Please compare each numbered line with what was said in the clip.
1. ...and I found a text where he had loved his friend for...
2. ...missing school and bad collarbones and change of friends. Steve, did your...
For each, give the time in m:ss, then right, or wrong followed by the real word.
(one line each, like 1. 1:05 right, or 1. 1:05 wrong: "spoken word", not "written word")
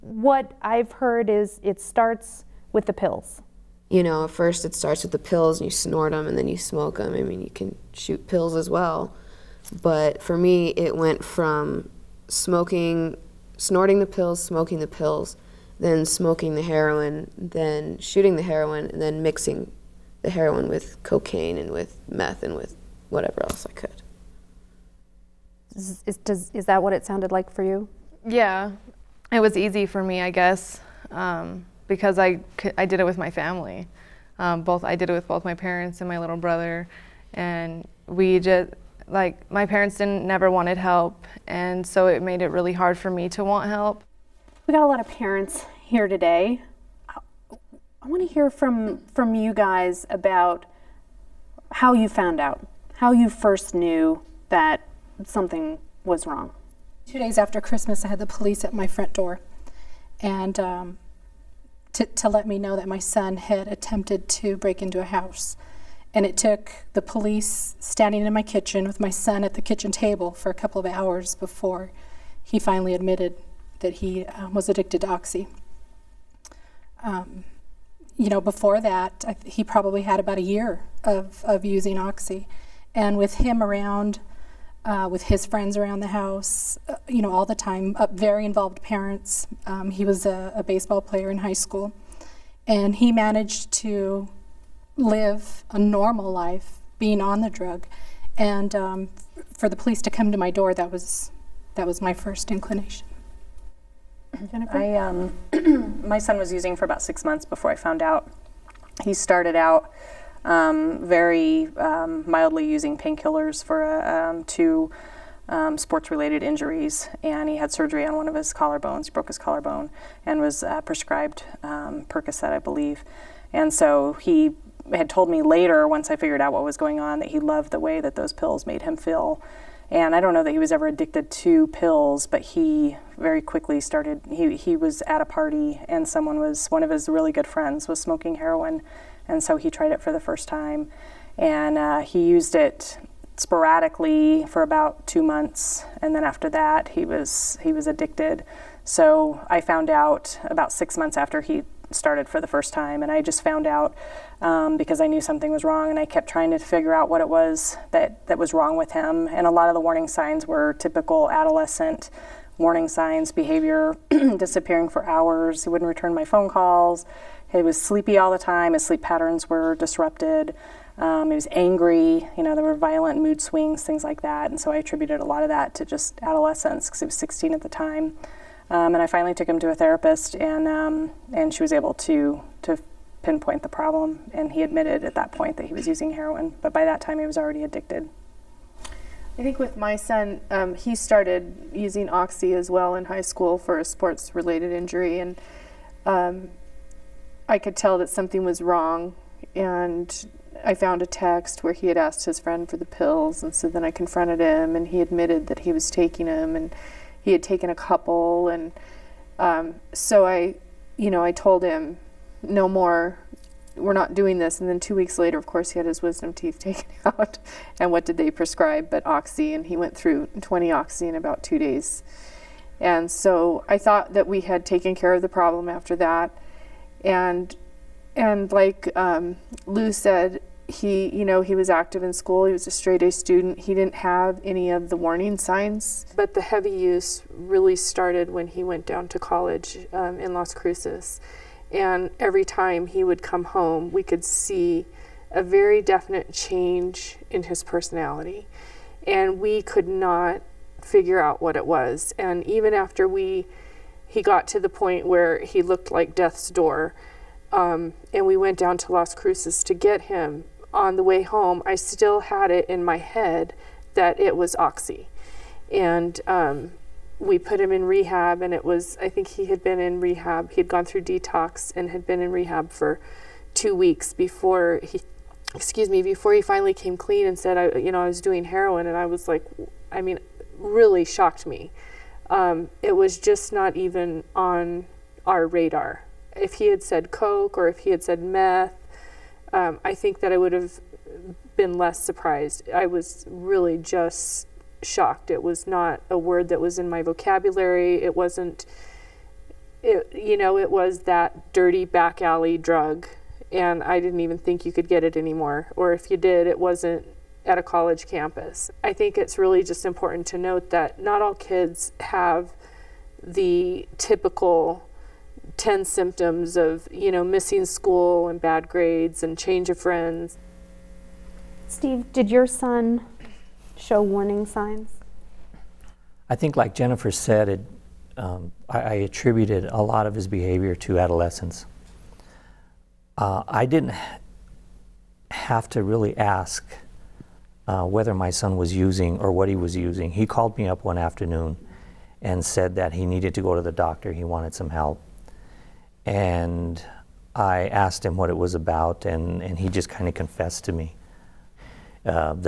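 1. 3:19 wrong: "asked", not "loved"
2. 5:17 wrong: "grades", not "collarbones".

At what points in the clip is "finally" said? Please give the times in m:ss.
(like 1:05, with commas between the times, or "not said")
1:12, 2:59, 4:36.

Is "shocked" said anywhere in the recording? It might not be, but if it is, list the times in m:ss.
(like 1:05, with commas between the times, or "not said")
4:41, 4:54.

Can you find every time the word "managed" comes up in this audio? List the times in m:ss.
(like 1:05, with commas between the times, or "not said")
1:33.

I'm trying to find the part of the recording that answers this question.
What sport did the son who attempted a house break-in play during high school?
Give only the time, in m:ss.
1:30.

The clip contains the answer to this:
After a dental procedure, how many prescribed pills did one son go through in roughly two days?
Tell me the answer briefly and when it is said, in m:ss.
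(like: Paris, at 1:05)
20, at 3:40.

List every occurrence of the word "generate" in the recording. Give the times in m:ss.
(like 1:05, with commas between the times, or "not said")
not said.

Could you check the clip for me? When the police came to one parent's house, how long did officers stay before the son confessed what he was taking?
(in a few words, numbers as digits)
a couple of hours.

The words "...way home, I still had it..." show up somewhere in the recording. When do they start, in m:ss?
4:21.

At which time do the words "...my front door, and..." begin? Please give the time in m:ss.
0:58.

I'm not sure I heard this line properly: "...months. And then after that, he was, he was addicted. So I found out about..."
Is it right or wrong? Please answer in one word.
right.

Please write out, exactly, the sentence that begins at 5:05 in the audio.
Or if you did, it wasn't at a college campus.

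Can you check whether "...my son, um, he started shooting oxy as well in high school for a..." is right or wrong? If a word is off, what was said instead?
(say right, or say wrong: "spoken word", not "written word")
wrong: "using", not "shooting".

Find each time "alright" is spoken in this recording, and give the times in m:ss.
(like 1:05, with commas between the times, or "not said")
not said.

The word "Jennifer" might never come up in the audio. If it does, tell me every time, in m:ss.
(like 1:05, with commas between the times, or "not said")
1:44, 5:26.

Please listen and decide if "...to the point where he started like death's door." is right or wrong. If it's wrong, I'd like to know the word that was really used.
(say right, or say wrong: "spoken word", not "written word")
wrong: "looked", not "started".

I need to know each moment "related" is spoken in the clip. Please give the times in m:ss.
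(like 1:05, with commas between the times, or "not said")
1:55, 3:13.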